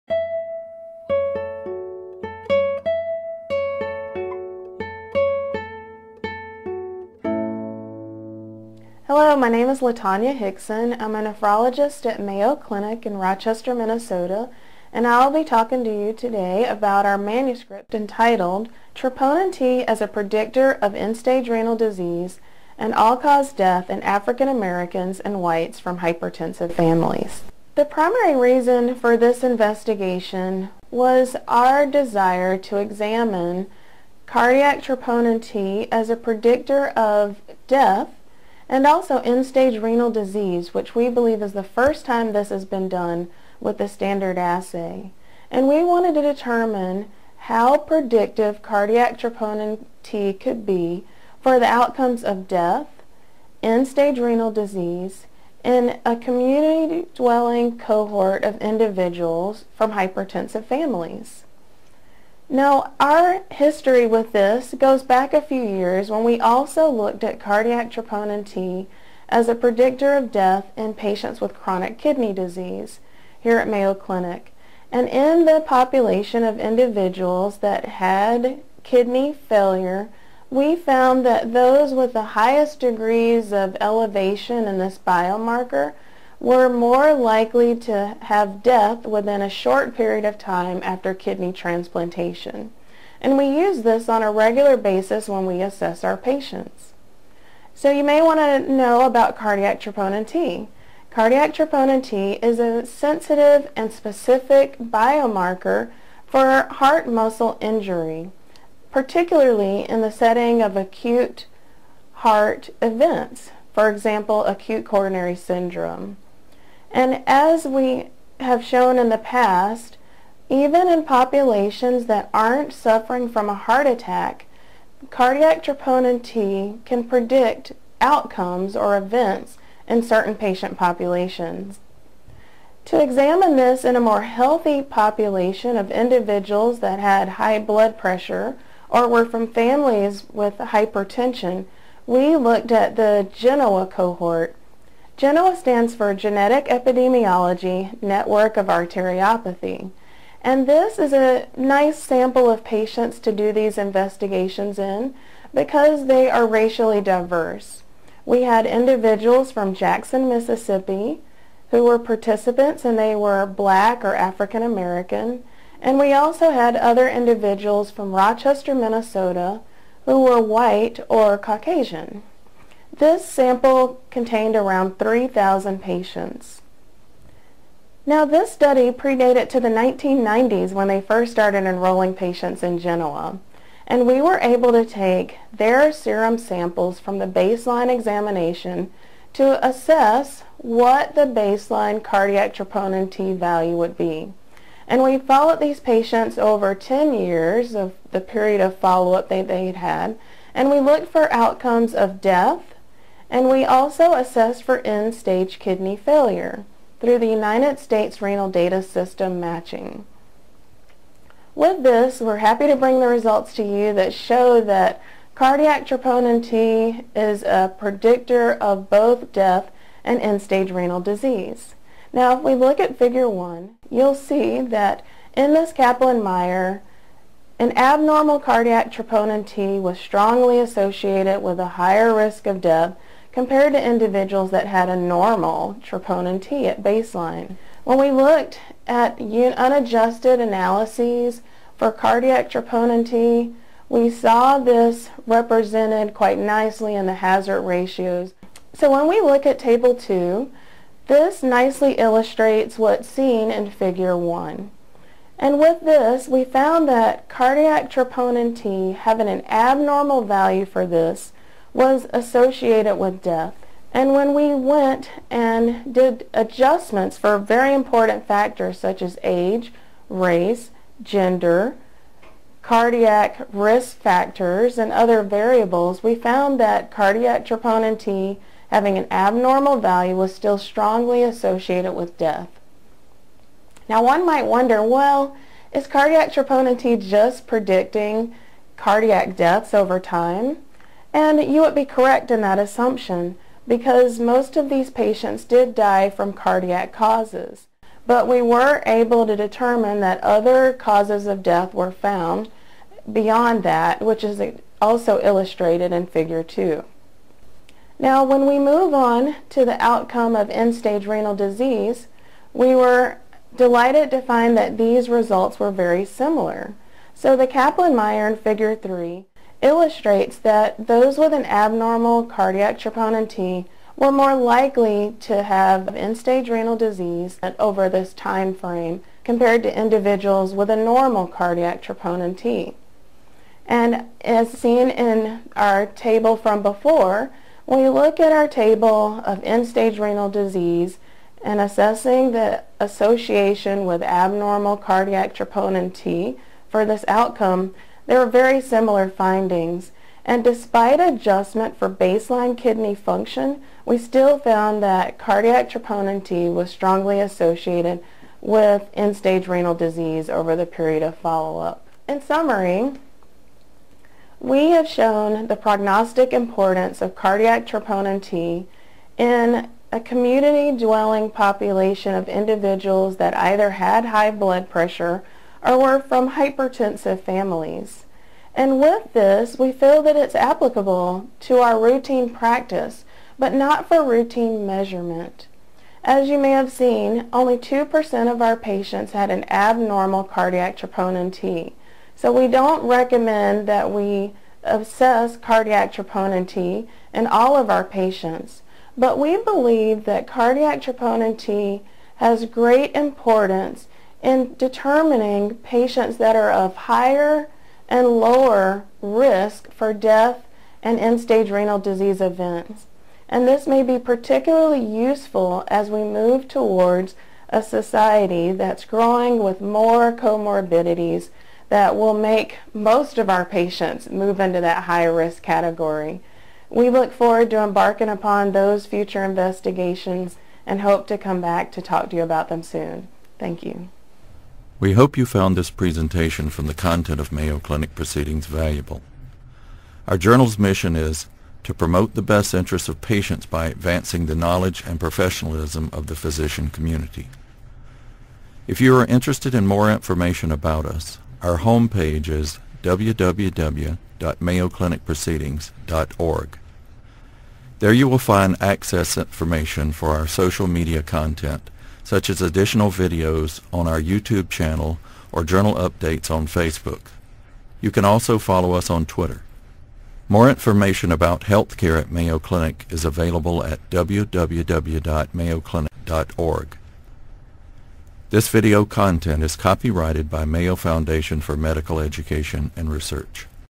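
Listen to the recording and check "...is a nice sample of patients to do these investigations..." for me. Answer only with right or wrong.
right.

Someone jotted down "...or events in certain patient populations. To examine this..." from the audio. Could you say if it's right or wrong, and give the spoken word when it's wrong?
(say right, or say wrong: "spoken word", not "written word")
right.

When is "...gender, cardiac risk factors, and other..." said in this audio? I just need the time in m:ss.
4:31.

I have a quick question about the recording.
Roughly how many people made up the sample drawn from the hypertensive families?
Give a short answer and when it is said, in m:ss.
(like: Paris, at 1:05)
3,000, at 2:54.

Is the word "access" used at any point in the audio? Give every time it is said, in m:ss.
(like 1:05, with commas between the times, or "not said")
7:38.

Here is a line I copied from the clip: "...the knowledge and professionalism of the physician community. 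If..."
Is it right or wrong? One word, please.
right.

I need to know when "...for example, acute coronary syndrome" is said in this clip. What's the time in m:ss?
1:53.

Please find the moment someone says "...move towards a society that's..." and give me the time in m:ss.
6:56.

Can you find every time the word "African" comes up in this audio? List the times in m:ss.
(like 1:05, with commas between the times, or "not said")
0:24, 2:44.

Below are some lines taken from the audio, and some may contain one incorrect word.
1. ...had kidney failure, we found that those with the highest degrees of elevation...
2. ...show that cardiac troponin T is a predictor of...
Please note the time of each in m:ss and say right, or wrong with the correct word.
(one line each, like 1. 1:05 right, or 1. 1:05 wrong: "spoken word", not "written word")
1. 1:17 right
2. 3:34 right.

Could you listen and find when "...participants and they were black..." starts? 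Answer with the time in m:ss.
2:41.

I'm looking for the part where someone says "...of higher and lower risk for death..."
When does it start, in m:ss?
6:46.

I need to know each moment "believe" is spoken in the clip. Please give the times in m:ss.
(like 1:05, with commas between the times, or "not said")
0:41, 6:39.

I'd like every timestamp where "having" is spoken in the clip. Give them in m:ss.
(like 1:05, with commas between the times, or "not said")
4:18, 4:38.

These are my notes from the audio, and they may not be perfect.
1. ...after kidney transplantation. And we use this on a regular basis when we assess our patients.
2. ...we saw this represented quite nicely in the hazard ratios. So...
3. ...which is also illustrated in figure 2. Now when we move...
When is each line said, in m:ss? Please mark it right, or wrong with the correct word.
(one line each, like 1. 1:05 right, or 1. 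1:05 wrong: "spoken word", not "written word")
1. 1:30 right
2. 4:03 right
3. 5:04 right.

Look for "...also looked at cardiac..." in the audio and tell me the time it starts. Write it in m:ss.
1:06.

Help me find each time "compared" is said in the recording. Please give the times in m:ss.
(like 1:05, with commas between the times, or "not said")
3:53, 5:29.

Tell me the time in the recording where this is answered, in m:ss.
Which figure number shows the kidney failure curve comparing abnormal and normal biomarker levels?
5:18.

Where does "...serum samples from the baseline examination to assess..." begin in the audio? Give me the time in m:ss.
3:05.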